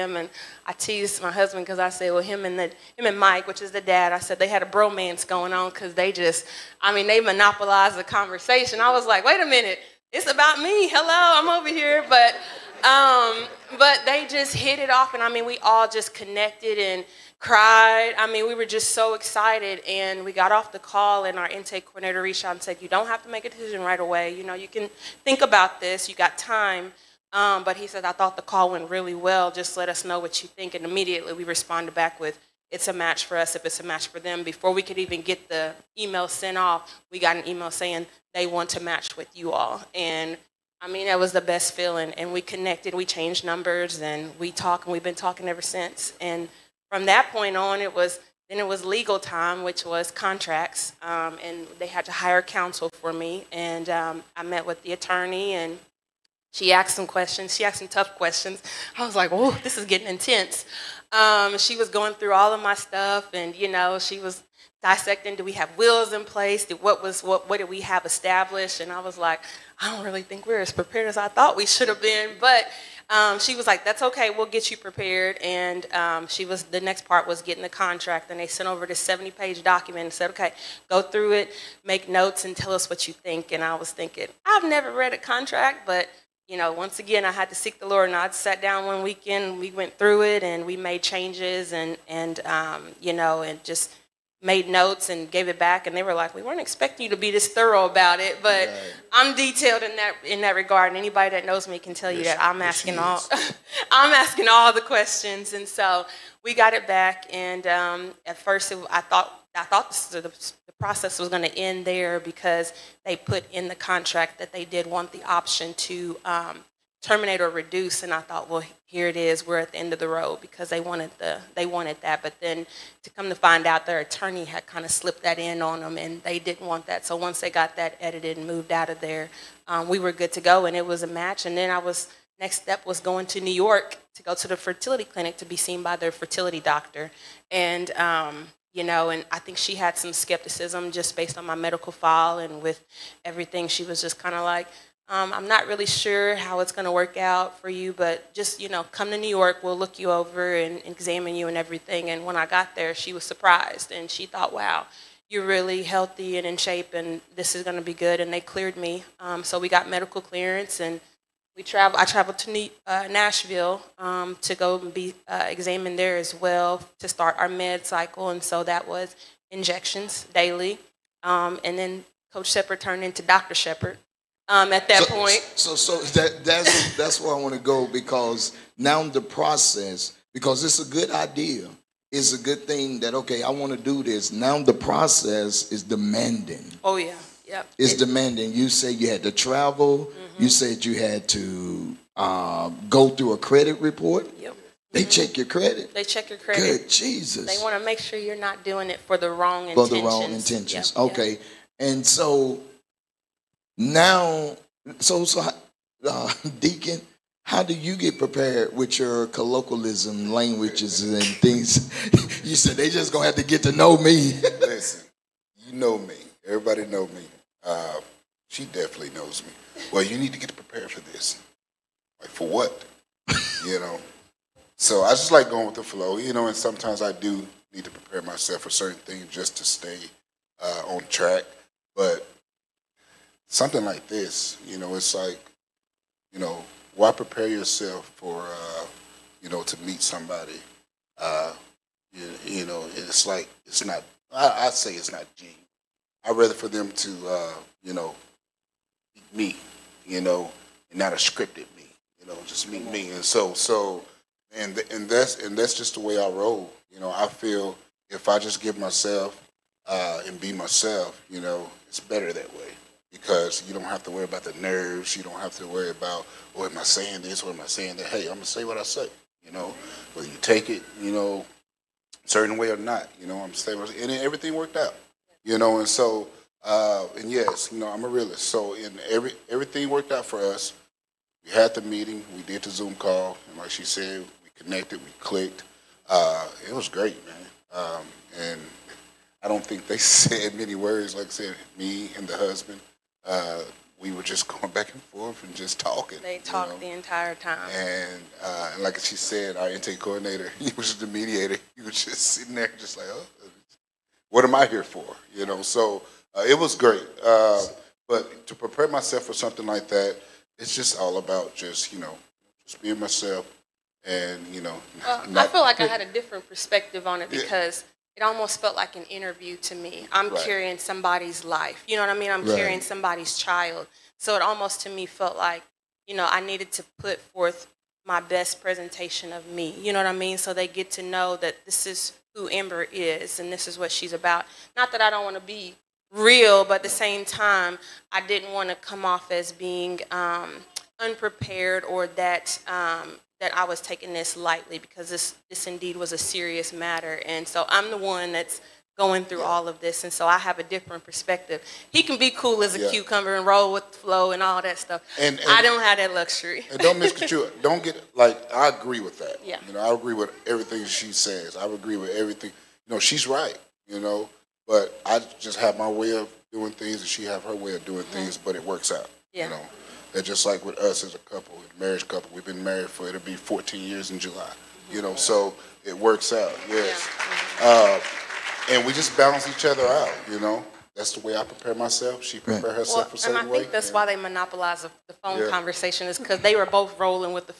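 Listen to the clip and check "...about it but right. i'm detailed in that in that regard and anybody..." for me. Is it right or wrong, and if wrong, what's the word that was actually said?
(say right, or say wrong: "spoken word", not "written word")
right.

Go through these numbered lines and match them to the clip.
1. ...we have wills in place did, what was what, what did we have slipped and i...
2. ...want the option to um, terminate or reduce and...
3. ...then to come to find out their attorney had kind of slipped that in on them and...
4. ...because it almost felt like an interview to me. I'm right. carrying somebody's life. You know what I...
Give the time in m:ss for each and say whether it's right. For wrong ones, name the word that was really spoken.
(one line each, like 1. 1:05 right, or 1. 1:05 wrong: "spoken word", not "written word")
1. 1:05 wrong: "established", not "slipped"
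2. 1:54 right
3. 2:02 right
4. 5:17 right.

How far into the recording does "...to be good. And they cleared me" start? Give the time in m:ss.
2:37.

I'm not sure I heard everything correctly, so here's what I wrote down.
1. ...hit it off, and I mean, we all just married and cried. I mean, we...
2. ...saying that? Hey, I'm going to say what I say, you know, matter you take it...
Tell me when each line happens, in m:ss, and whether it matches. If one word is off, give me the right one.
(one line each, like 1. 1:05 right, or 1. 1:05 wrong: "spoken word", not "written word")
1. 0:14 wrong: "connected", not "married"
2. 4:27 wrong: "whether", not "matter".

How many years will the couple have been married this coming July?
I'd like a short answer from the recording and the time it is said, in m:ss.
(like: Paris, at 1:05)
14, at 6:13.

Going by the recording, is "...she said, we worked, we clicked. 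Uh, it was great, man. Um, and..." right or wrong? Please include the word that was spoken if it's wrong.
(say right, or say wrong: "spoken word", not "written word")
wrong: "connected", not "worked".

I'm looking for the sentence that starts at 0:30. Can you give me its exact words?
And immediately we responded back with, It's a match for us if it's a match for them.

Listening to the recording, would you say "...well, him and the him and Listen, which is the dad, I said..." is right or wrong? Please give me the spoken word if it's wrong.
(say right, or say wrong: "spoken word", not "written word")
wrong: "Mike", not "Listen".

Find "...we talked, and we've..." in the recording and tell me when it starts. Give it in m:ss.
0:44.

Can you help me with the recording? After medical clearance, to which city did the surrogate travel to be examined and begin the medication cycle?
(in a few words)
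Nashville.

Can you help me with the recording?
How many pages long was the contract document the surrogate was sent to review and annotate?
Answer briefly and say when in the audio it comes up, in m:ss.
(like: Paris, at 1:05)
70, at 1:19.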